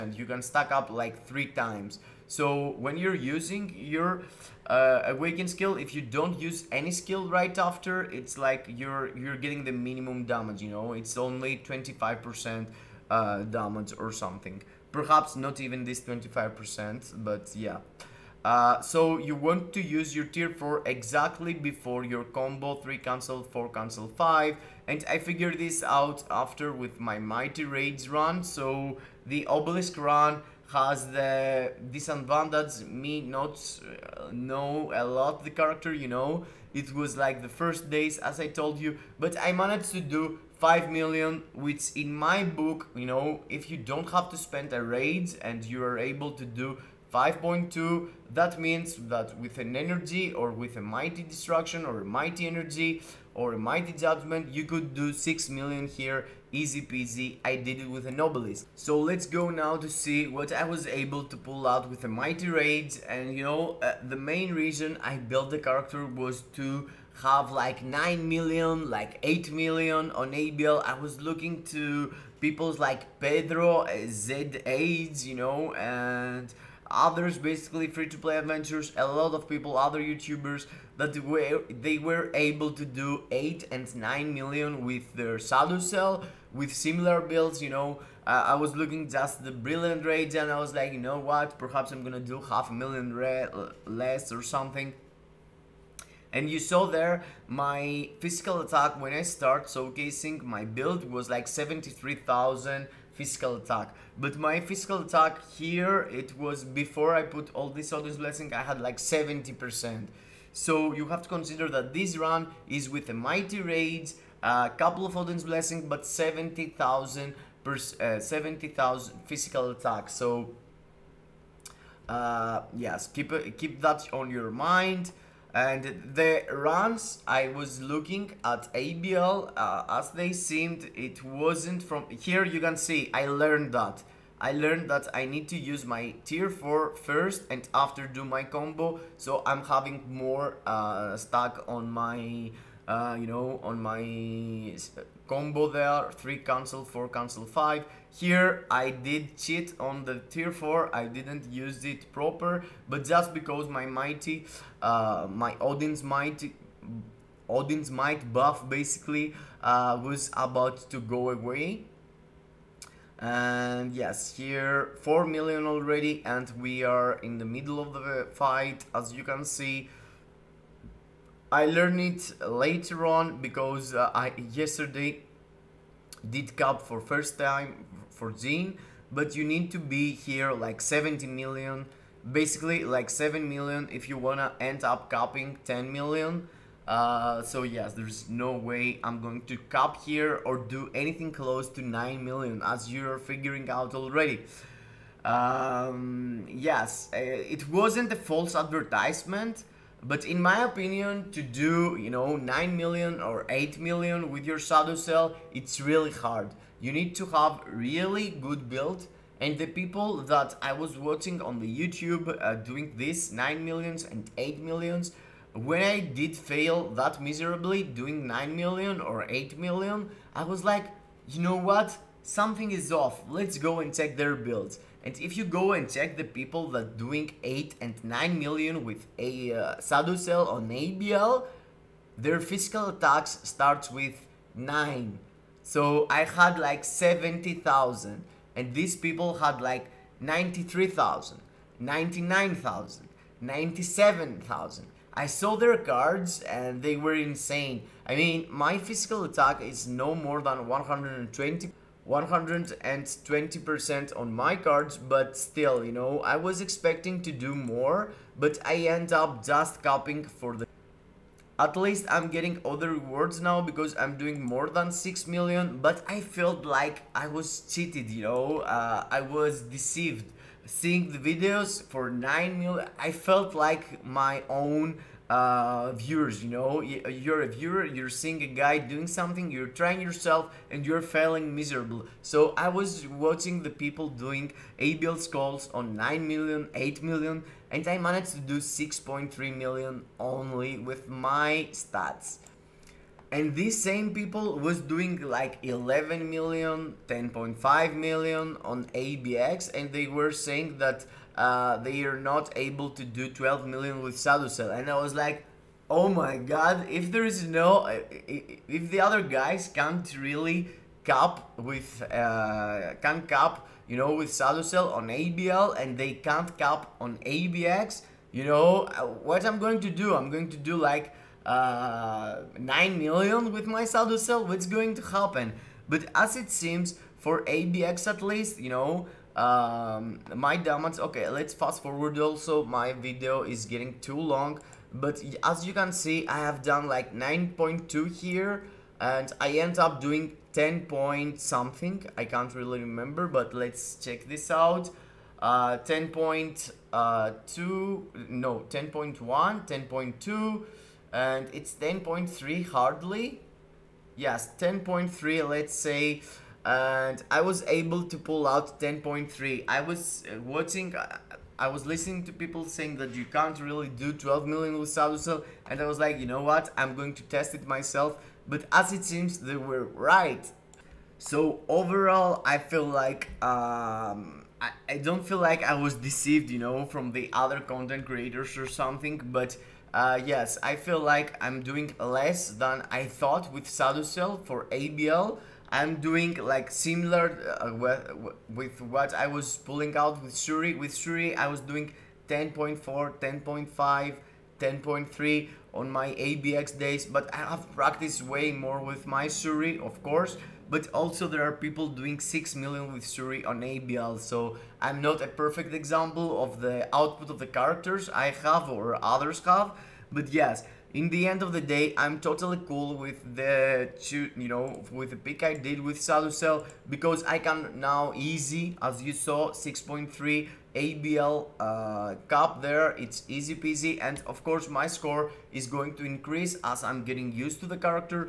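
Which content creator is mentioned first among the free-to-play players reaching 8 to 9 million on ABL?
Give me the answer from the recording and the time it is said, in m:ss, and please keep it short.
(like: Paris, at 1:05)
Pedro, at 1:13.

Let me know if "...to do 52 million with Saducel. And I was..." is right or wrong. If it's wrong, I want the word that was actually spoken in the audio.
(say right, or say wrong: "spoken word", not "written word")
wrong: "12", not "52".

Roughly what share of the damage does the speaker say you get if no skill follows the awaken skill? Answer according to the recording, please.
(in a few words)
25%.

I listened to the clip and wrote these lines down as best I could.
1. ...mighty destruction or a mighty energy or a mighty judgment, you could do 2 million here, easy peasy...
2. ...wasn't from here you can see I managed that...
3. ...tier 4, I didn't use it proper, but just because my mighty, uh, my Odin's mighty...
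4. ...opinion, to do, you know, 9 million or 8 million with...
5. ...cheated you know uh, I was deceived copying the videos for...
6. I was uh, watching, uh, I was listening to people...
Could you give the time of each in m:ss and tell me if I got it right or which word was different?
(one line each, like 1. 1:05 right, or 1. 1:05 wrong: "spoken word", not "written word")
1. 0:50 wrong: "6", not "2"
2. 2:11 wrong: "learned", not "managed"
3. 2:30 right
4. 3:20 right
5. 4:27 wrong: "seeing", not "copying"
6. 5:59 right.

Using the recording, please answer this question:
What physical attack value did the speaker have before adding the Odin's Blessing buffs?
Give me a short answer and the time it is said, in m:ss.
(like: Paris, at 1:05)
70,000, at 1:58.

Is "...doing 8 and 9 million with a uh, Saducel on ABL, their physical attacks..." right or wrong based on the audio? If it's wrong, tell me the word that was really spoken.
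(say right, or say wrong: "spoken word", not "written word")
right.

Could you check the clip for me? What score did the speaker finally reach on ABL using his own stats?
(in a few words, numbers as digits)
6.3 million.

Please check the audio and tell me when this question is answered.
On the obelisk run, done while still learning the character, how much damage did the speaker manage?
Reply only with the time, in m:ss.
0:47.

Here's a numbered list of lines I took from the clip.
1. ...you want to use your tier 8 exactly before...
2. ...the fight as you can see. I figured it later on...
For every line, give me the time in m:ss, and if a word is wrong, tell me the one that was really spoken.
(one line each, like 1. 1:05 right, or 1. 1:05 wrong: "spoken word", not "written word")
1. 0:19 wrong: "4", not "8"
2. 2:47 wrong: "learned", not "figured".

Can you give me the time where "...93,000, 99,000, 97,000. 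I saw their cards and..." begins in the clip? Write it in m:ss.
4:00.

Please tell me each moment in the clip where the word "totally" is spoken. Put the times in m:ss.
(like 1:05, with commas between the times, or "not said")
6:52.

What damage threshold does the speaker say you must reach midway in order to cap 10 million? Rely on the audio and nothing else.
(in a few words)
7 million.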